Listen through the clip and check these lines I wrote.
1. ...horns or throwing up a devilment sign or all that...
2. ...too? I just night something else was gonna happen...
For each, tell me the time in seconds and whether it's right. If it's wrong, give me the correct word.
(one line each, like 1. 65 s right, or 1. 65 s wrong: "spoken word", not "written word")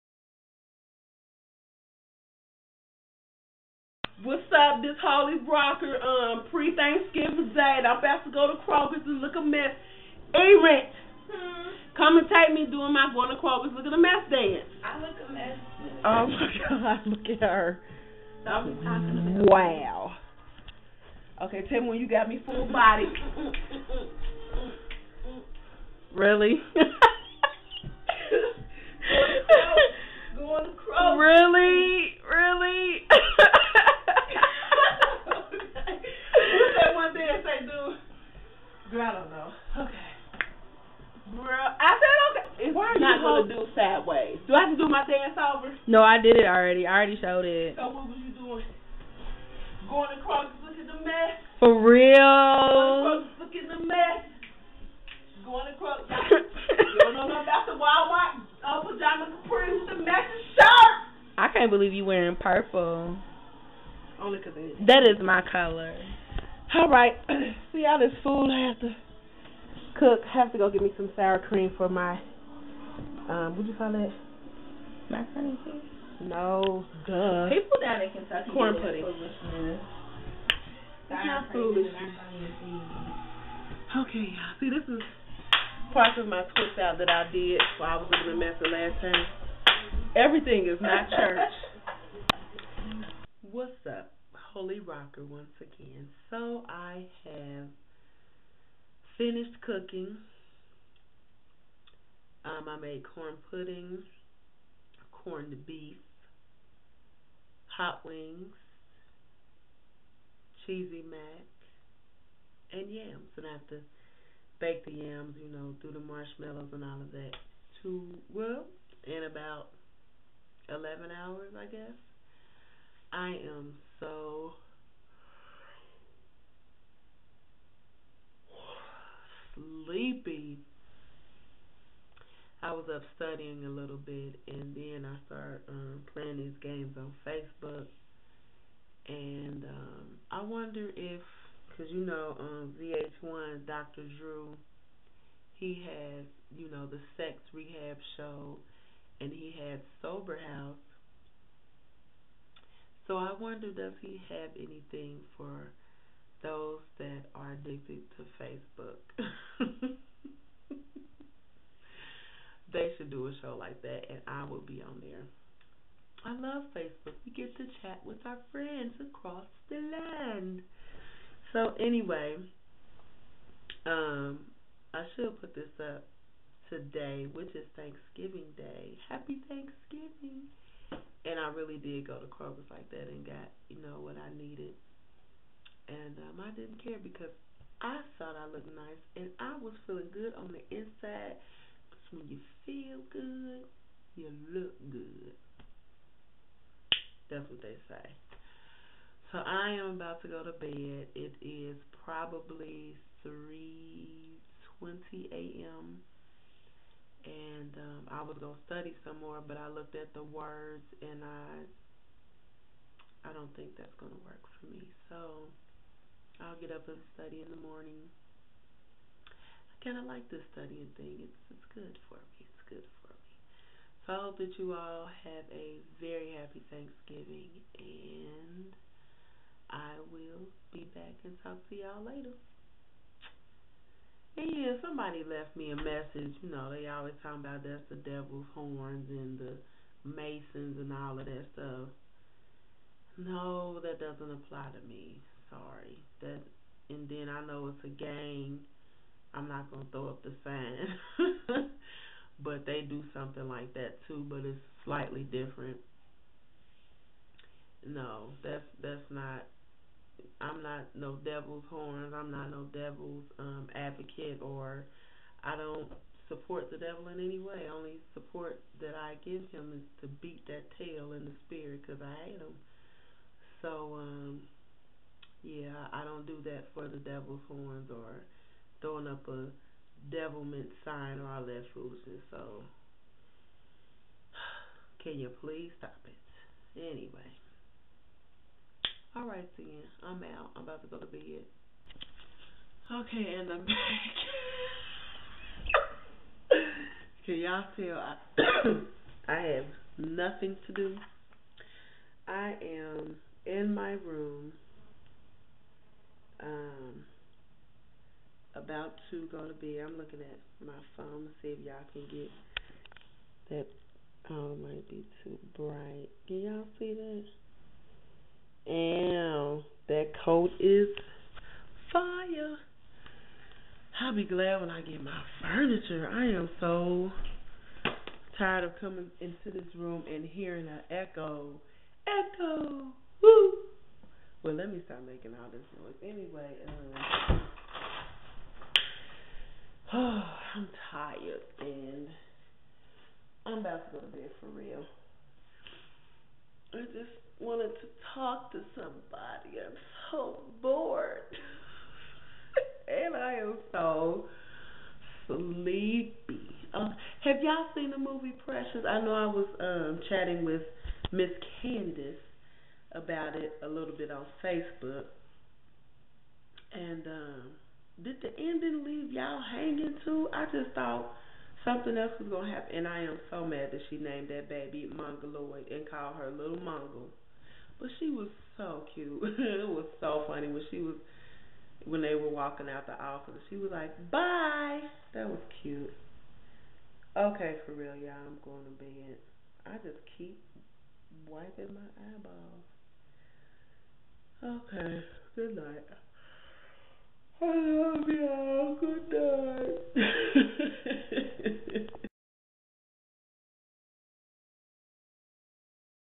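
1. 277 s right
2. 370 s wrong: "thought", not "night".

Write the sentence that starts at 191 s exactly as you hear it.
Cause when you feel good, you look good.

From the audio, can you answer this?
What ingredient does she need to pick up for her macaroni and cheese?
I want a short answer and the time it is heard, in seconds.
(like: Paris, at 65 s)
Sour cream, at 71 s.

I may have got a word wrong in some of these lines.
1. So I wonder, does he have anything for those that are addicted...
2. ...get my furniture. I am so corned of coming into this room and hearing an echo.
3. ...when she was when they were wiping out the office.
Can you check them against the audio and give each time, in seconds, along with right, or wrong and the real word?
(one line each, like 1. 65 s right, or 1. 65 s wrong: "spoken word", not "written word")
1. 153 s right
2. 324 s wrong: "tired", not "corned"
3. 380 s wrong: "walking", not "wiping".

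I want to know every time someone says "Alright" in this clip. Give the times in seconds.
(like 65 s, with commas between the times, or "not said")
289 s.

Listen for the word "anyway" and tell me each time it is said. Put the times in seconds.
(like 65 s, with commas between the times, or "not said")
171 s, 286 s, 336 s.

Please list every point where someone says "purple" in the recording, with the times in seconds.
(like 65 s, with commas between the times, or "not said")
62 s.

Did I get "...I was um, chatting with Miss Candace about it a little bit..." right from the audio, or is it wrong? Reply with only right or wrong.
right.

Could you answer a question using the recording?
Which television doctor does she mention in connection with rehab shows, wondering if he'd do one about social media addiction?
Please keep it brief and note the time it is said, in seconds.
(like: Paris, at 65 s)
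Dr. Drew, at 143 s.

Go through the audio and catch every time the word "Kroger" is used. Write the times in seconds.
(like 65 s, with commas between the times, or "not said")
8 s, 13 s, 182 s.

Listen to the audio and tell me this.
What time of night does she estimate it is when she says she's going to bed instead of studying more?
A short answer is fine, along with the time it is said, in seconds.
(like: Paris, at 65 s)
3:20 a.m., at 203 s.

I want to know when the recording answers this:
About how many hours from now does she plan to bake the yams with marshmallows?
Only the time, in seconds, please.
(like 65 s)
120 s.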